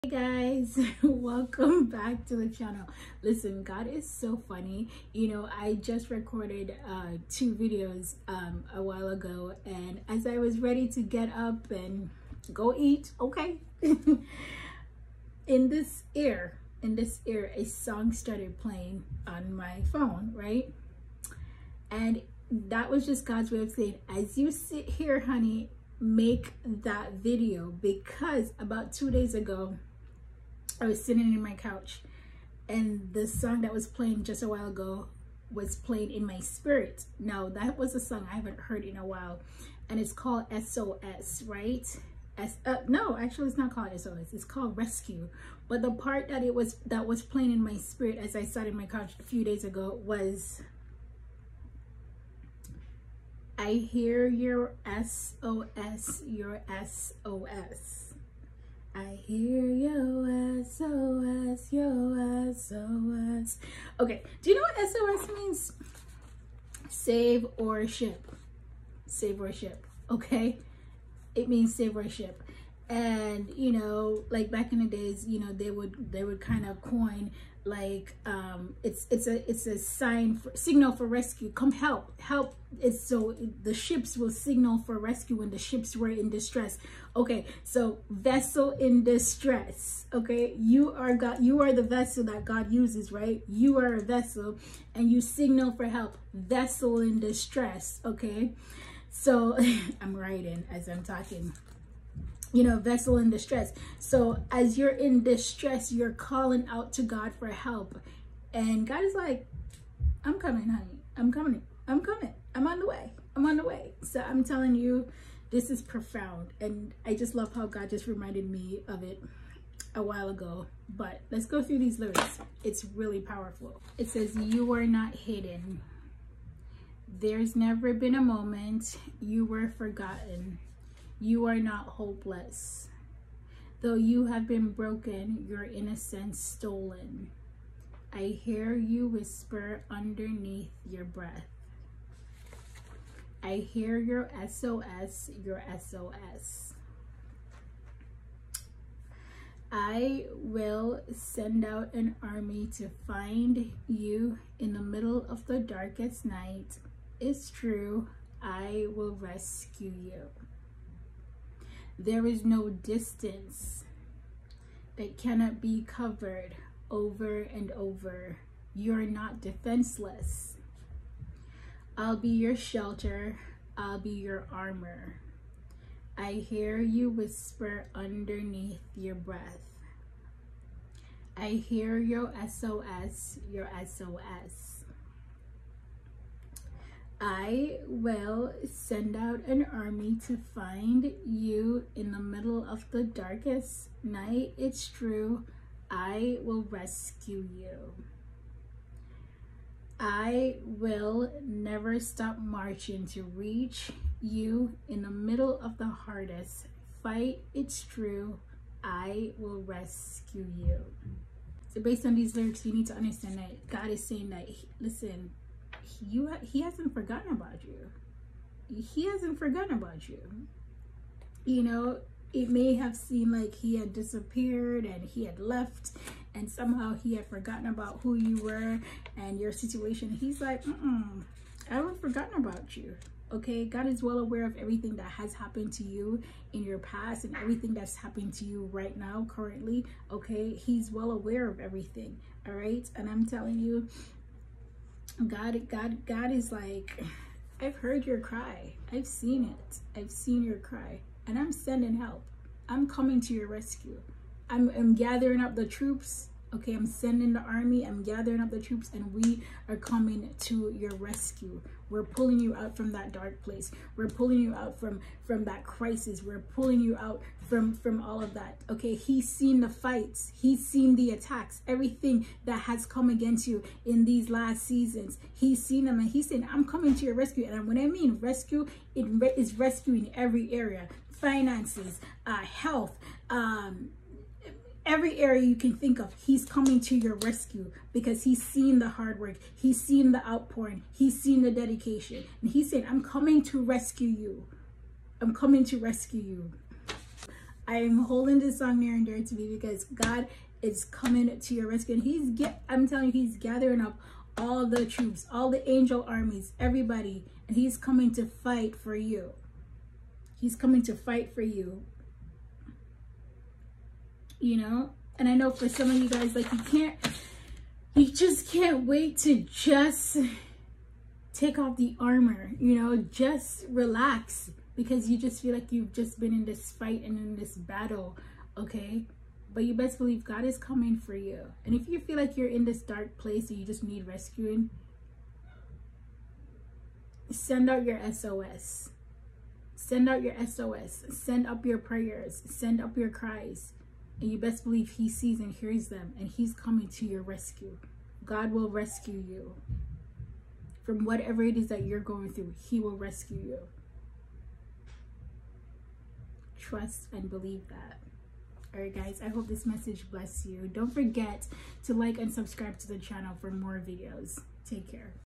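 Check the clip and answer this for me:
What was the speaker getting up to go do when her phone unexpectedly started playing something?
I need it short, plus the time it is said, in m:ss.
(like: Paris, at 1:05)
Go eat, at 0:12.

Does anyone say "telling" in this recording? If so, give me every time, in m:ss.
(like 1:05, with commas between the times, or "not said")
1:54, 4:03, 5:02.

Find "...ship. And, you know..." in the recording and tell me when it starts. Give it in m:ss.
1:12.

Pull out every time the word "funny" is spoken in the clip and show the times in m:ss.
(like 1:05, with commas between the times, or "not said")
0:04.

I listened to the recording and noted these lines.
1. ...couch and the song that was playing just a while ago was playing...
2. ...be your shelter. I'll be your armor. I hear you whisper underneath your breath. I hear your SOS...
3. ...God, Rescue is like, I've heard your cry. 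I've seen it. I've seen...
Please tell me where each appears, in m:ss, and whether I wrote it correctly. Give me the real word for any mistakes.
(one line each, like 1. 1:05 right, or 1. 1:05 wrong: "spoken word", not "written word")
1. 0:31 right
2. 2:52 right
3. 4:05 wrong: "God", not "Rescue".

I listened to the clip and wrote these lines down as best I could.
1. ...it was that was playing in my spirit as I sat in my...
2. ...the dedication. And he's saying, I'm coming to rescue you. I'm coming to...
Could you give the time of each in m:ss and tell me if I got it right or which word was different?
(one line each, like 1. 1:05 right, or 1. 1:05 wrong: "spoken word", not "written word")
1. 0:46 right
2. 4:51 right.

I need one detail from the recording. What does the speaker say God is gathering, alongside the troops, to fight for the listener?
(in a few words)
Angel armies.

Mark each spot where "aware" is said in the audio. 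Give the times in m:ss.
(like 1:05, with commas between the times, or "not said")
3:54, 4:01.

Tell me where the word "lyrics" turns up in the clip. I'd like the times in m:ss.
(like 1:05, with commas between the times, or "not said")
2:01, 3:32.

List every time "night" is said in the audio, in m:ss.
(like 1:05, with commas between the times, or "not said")
2:36, 3:14.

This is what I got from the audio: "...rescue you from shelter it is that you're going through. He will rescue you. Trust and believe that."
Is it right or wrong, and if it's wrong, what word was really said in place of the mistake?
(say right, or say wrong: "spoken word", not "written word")
wrong: "whatever", not "shelter".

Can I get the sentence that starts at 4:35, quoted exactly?
He's seen them and he's saying, I'm coming to your rescue.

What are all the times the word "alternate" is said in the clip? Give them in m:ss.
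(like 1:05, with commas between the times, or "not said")
not said.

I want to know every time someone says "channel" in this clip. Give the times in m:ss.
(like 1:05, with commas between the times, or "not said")
0:02, 6:02.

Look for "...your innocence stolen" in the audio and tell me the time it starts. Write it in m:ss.
2:15.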